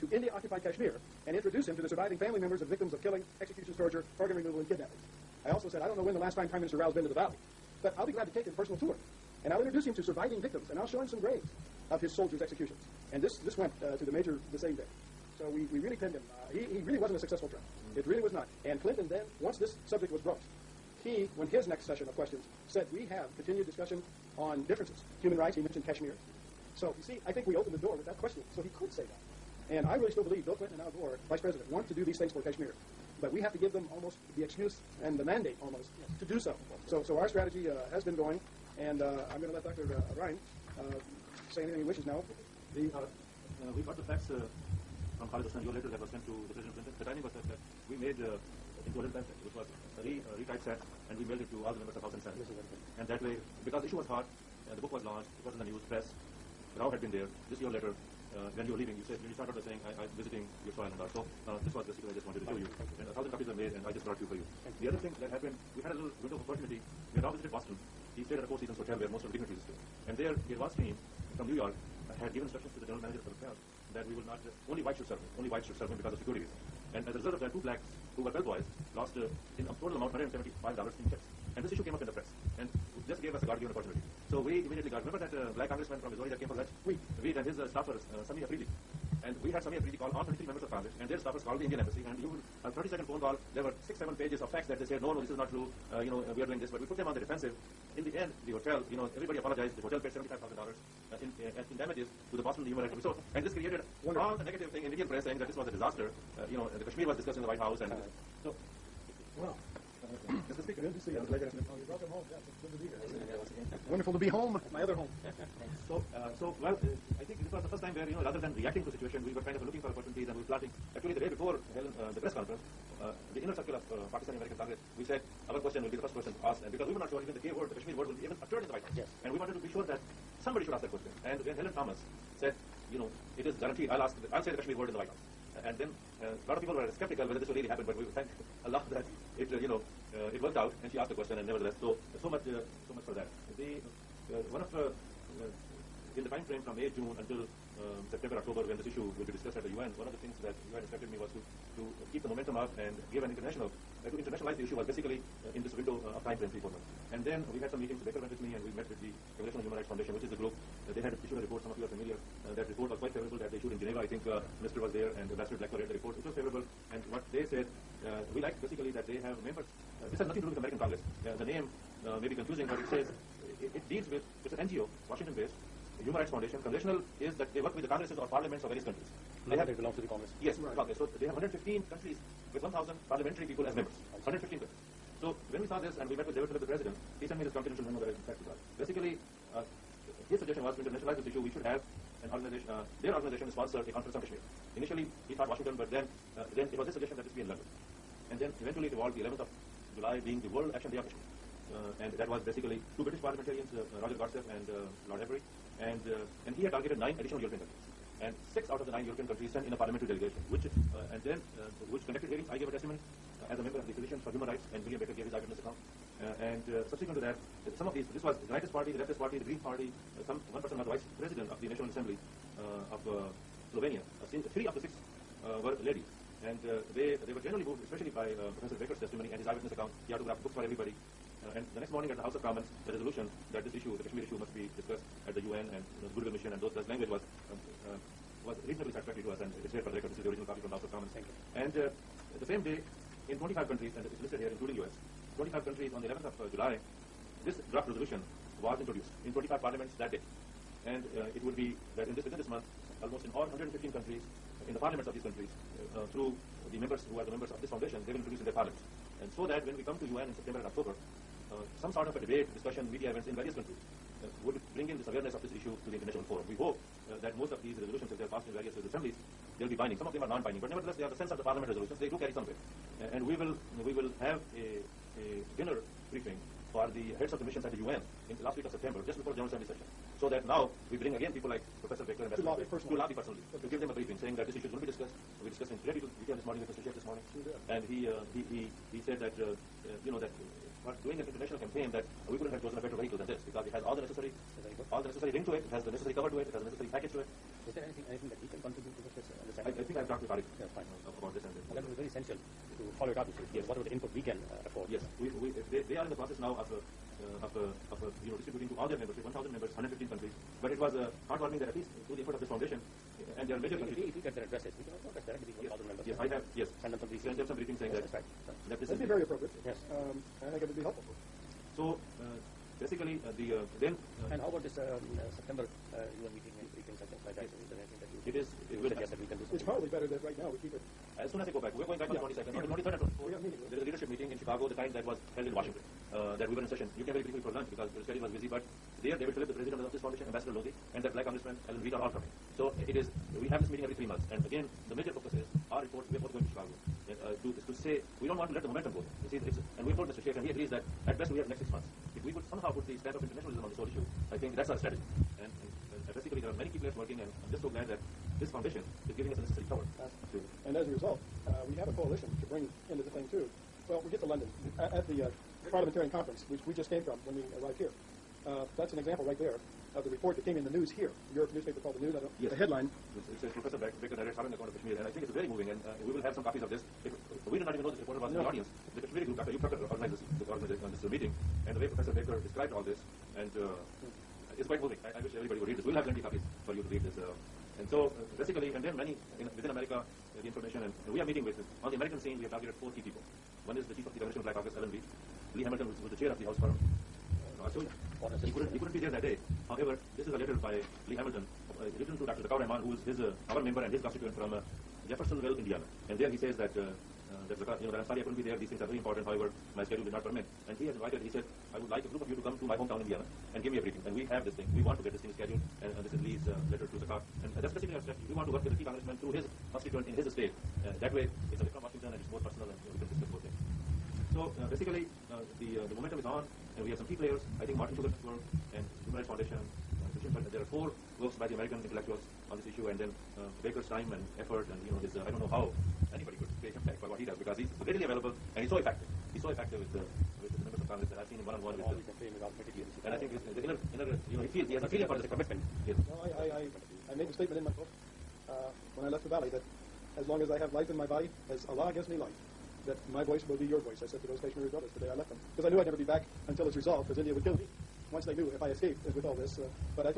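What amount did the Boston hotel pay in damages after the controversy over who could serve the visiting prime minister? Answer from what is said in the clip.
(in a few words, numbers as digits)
$75,000.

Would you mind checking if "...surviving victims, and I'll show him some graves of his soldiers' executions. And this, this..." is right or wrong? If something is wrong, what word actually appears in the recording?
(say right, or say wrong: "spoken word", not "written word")
right.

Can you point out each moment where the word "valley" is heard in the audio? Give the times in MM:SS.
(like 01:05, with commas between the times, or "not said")
00:07, 07:29.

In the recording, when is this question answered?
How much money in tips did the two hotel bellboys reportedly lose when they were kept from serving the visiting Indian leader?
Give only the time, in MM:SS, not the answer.
01:20.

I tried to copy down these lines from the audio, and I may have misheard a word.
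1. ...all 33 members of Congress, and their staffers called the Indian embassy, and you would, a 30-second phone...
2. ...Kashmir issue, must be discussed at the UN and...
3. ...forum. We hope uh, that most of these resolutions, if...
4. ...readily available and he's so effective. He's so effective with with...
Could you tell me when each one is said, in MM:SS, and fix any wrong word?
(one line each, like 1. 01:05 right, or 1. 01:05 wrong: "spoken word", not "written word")
1. 01:30 right
2. 03:54 right
3. 04:26 right
4. 07:17 right.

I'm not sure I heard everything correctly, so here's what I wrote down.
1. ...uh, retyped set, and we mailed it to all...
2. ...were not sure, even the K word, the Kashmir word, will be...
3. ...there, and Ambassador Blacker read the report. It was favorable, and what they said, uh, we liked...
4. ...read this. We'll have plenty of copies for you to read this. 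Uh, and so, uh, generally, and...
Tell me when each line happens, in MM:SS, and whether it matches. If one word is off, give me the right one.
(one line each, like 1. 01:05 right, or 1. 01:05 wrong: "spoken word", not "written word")
1. 00:50 right
2. 02:06 right
3. 02:44 right
4. 06:25 wrong: "basically", not "generally".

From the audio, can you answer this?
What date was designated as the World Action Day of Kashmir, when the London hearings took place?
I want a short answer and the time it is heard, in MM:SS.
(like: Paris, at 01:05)
11th of July, at 03:19.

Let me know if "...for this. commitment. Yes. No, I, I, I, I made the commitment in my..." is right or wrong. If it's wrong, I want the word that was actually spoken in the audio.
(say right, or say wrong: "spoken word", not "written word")
wrong: "statement", not "commitment".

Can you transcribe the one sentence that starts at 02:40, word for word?
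Uh, they had issued a report.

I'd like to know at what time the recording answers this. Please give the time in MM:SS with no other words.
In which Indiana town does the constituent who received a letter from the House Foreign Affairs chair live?
06:45.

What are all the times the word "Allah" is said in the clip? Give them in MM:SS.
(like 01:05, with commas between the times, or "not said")
02:18, 07:31.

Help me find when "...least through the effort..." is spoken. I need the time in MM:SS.
05:11.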